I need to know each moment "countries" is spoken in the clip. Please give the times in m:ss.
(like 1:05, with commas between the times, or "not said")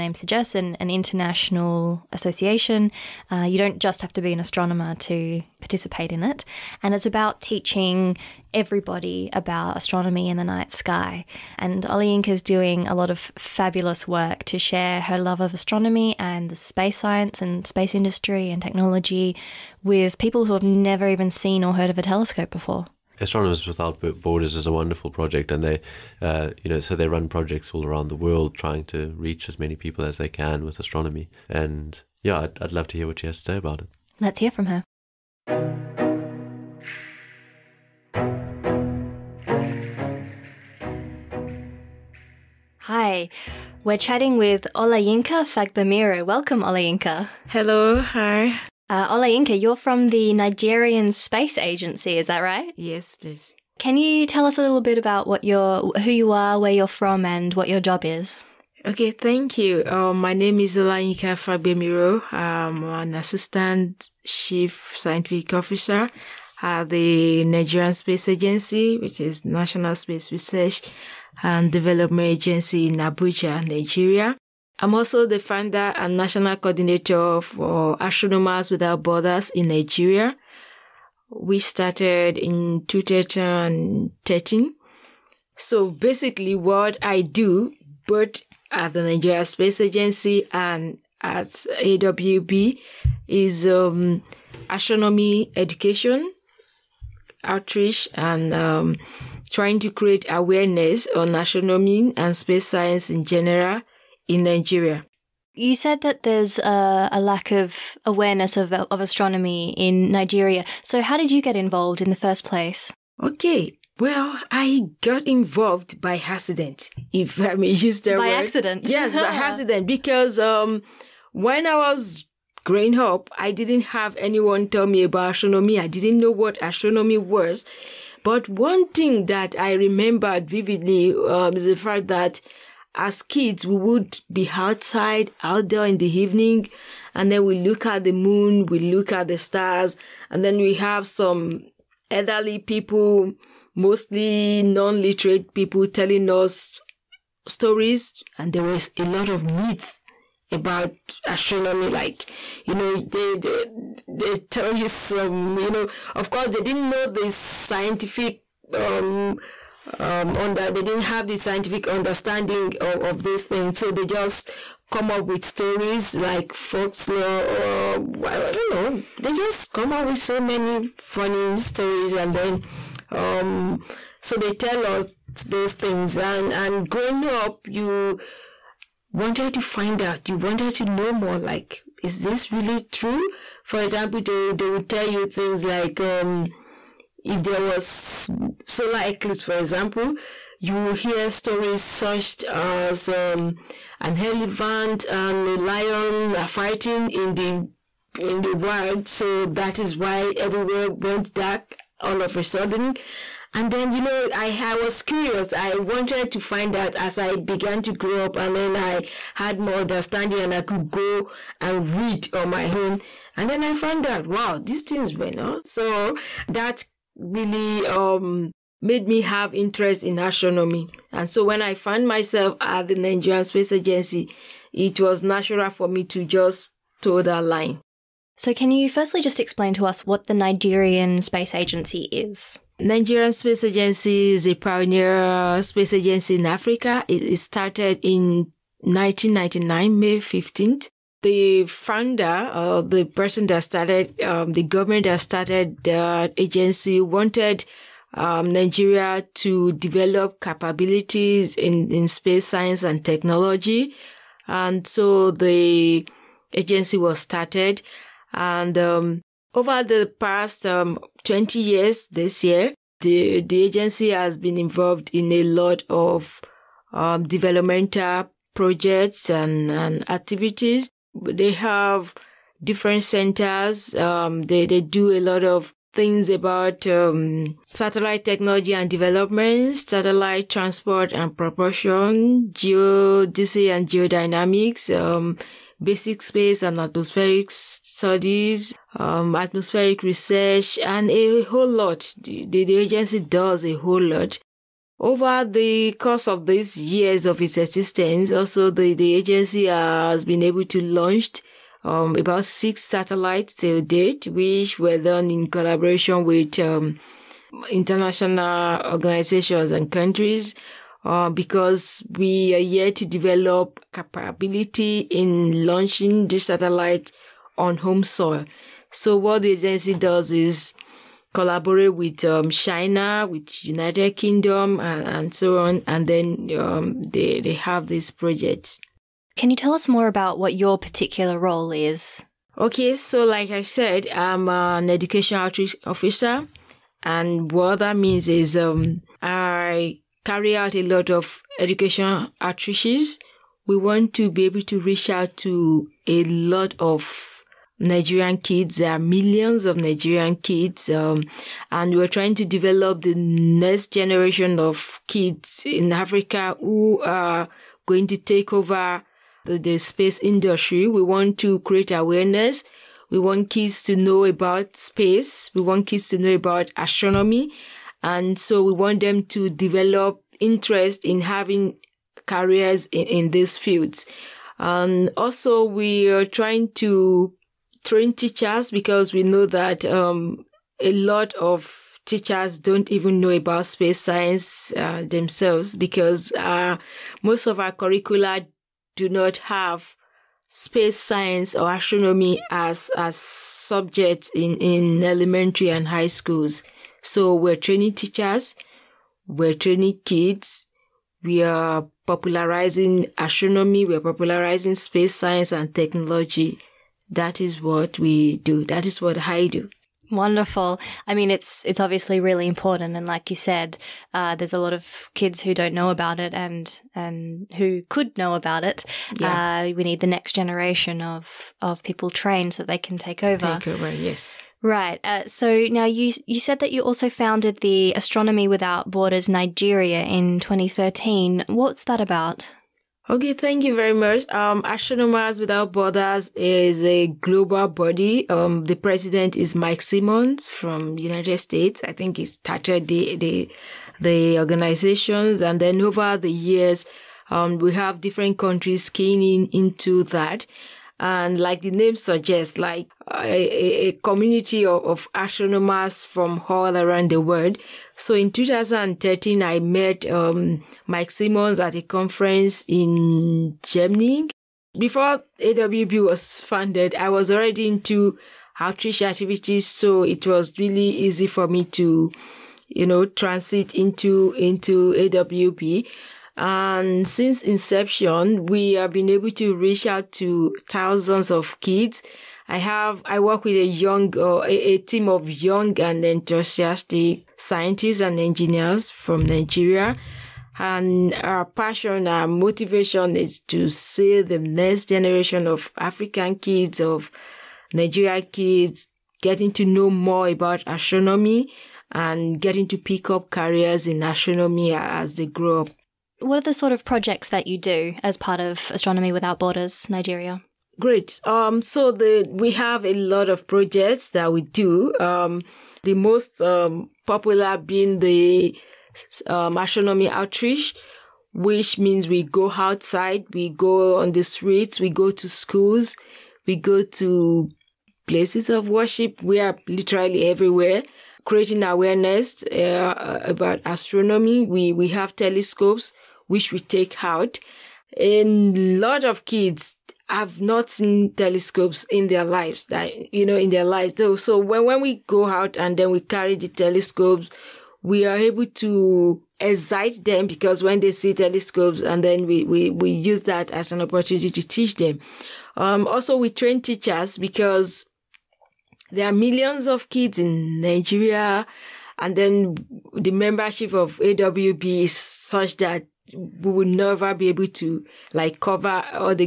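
5:09, 7:28.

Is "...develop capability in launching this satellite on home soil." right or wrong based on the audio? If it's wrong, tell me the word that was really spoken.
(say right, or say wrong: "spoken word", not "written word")
right.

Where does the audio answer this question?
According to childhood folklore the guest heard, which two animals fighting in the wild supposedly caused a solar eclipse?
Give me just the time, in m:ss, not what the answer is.
3:14.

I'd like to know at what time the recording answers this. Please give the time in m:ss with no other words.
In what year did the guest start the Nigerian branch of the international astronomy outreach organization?
1:21.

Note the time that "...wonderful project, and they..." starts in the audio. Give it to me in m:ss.
0:24.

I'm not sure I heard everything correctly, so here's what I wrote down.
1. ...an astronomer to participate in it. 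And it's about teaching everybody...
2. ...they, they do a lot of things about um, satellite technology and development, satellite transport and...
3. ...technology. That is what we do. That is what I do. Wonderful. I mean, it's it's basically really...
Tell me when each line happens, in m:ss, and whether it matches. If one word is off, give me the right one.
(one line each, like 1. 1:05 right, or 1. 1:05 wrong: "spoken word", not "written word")
1. 0:04 right
2. 4:34 right
3. 6:45 wrong: "obviously", not "basically".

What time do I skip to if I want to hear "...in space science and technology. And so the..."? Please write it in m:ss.
4:11.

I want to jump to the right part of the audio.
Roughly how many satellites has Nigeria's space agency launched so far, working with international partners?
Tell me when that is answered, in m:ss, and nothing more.
5:02.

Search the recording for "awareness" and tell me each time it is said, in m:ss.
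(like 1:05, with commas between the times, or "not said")
1:40, 1:48, 6:01, 8:51.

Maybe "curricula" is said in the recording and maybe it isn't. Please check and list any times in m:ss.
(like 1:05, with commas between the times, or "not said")
6:27.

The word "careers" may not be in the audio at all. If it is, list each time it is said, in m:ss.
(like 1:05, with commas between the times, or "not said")
6:12, 8:23.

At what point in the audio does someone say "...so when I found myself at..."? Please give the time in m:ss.
3:41.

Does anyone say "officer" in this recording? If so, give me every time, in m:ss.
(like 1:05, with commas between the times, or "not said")
1:05, 5:35.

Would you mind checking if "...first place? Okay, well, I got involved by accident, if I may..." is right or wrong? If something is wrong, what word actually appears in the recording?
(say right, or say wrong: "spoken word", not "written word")
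right.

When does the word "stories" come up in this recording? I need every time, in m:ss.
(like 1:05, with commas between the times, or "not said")
2:27, 2:45, 2:51, 3:11.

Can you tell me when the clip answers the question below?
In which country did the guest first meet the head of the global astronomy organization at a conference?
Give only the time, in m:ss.
7:43.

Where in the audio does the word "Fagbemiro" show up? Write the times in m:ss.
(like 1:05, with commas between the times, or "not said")
0:45, 1:01.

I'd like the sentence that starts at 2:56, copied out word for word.
And, and growing up, you wanted to find out, you wanted to know more, like, is this really true?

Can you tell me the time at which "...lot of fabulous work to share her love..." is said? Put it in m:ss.
0:12.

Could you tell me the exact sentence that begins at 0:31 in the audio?
And yeah, I'd, I'd love to hear what she has to say about it.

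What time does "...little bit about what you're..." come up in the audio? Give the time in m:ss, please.
0:54.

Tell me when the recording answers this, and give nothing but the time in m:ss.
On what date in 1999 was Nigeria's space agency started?
3:59.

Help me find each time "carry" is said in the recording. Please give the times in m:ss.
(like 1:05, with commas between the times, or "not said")
5:40, 9:05.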